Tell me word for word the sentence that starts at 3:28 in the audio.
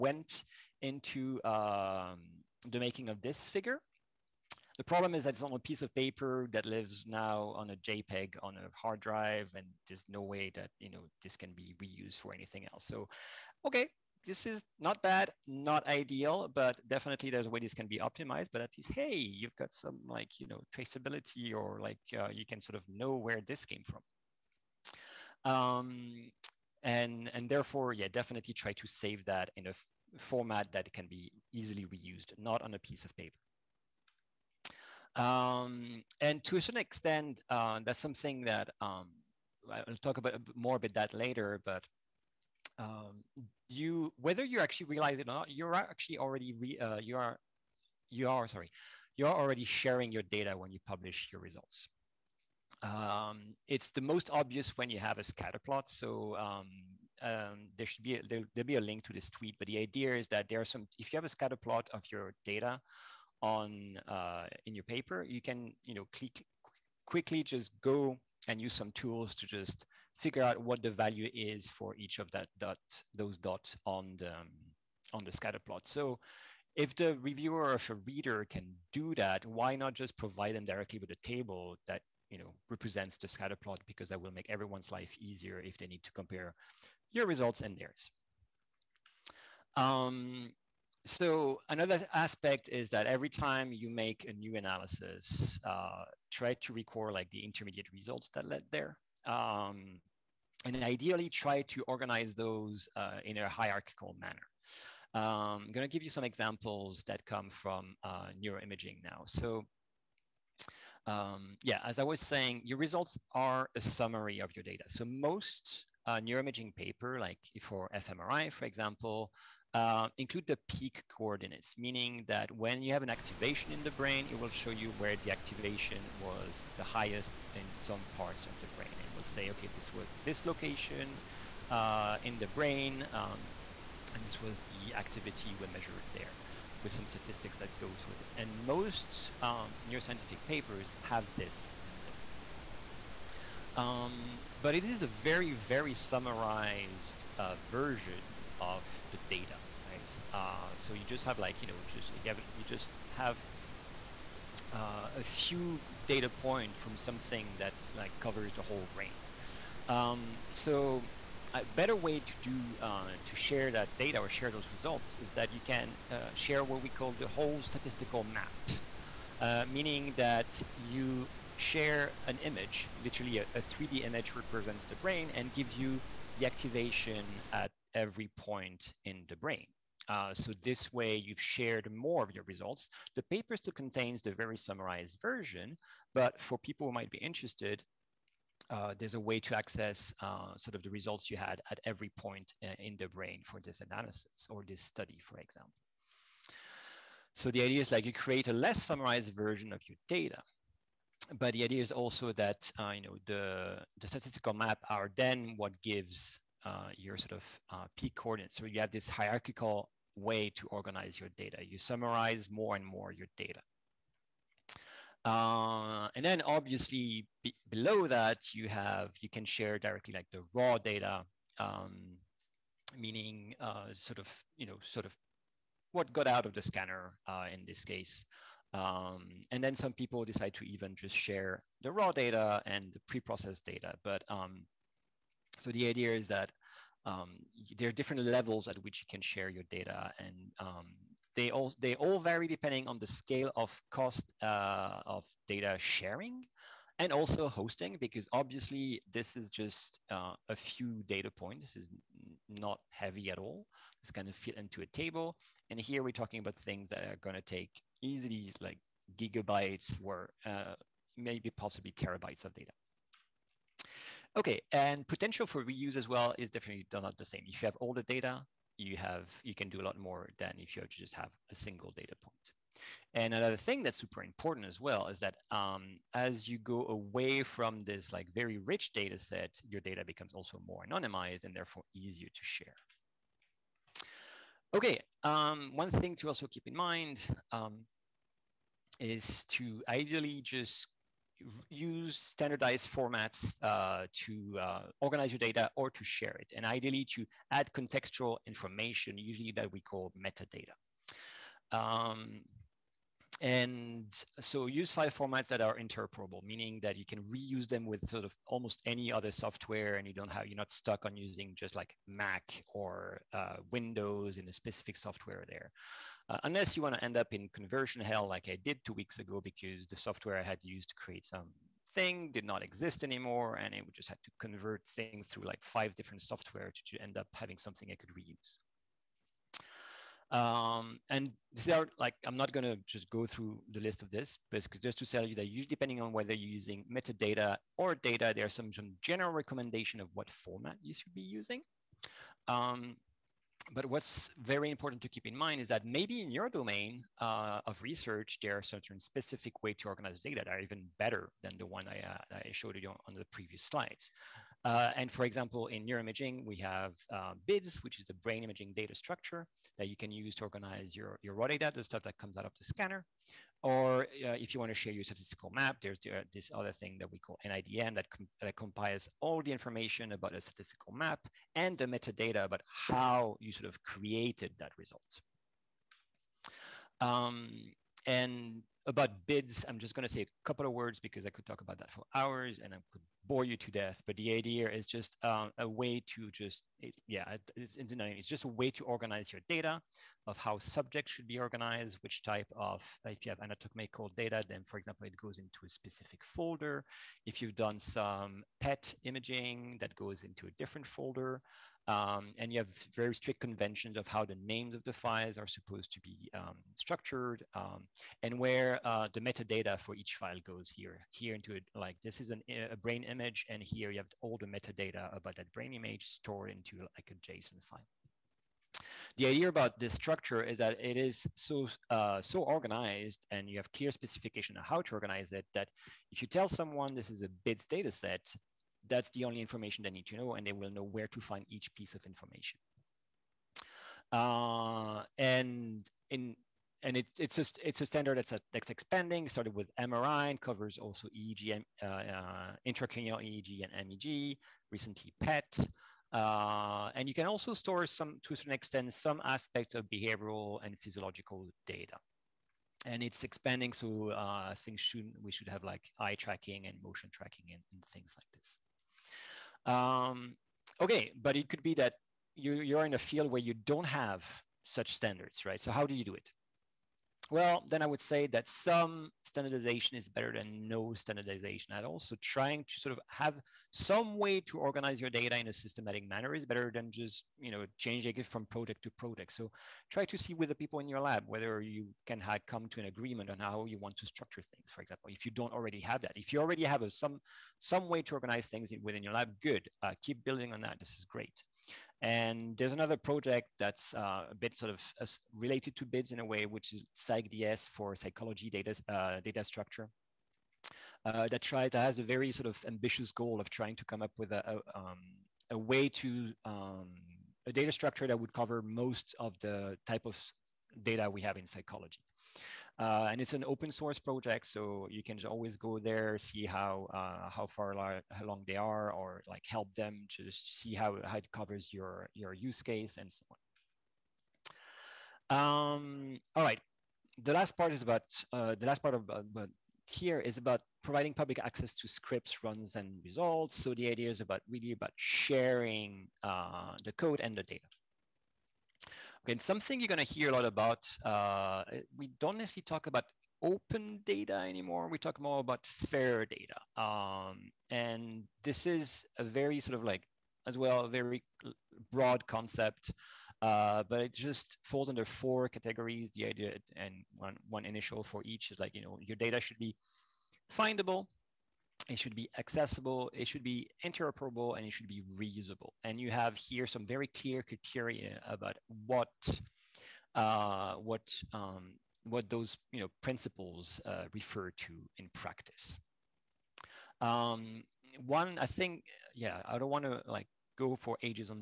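So you have this hierarchical way to organize your data.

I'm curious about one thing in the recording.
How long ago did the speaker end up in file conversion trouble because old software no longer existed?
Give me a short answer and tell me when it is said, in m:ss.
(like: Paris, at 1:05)
Two weeks ago, at 5:18.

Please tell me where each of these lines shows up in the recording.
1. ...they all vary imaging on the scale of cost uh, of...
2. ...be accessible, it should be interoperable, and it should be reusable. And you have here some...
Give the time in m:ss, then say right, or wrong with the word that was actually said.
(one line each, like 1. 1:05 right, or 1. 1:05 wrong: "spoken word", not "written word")
1. 4:01 wrong: "depending", not "imaging"
2. 9:22 right.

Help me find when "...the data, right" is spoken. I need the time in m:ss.
2:29.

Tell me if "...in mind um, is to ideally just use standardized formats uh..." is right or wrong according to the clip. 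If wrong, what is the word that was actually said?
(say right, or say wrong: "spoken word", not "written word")
right.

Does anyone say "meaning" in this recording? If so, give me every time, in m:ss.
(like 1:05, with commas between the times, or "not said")
2:01, 2:49, 3:42, 5:06.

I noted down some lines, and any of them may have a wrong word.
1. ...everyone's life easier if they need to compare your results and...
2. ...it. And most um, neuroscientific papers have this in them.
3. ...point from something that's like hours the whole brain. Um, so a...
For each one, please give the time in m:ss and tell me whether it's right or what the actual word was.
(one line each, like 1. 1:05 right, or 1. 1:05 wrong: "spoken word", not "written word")
1. 1:24 right
2. 2:18 right
3. 2:36 wrong: "covers", not "hours".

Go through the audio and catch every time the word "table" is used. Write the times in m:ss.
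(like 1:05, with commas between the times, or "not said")
1:21, 4:14.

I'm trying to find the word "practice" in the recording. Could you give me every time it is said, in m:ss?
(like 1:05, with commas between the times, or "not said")
9:35.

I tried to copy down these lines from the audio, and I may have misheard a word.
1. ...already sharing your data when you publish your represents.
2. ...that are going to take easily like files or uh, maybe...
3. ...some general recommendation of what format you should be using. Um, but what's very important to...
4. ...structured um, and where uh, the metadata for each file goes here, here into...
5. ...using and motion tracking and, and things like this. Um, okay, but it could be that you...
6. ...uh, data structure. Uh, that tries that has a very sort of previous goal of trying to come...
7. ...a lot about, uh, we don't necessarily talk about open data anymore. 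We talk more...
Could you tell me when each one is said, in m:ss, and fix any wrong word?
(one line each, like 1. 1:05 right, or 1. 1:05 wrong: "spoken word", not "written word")
1. 0:49 wrong: "results", not "represents"
2. 4:16 wrong: "gigabytes", not "files"
3. 5:38 right
4. 6:46 right
5. 7:36 wrong: "tracking", not "using"
6. 8:18 wrong: "ambitious", not "previous"
7. 9:00 right.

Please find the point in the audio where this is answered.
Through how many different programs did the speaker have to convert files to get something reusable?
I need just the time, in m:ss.
5:25.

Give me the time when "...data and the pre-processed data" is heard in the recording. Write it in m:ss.
3:52.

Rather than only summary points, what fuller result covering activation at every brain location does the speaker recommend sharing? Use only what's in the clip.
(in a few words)
Whole statistical map.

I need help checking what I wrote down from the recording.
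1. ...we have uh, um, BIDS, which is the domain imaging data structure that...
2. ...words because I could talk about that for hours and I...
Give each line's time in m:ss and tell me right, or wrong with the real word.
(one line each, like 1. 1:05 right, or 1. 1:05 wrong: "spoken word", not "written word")
1. 5:56 wrong: "brain", not "domain"
2. 6:20 right.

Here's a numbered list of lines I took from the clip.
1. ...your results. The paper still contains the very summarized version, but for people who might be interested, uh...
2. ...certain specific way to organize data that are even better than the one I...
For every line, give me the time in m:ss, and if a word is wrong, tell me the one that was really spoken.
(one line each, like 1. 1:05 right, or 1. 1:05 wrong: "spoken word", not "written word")
1. 3:02 right
2. 5:48 right.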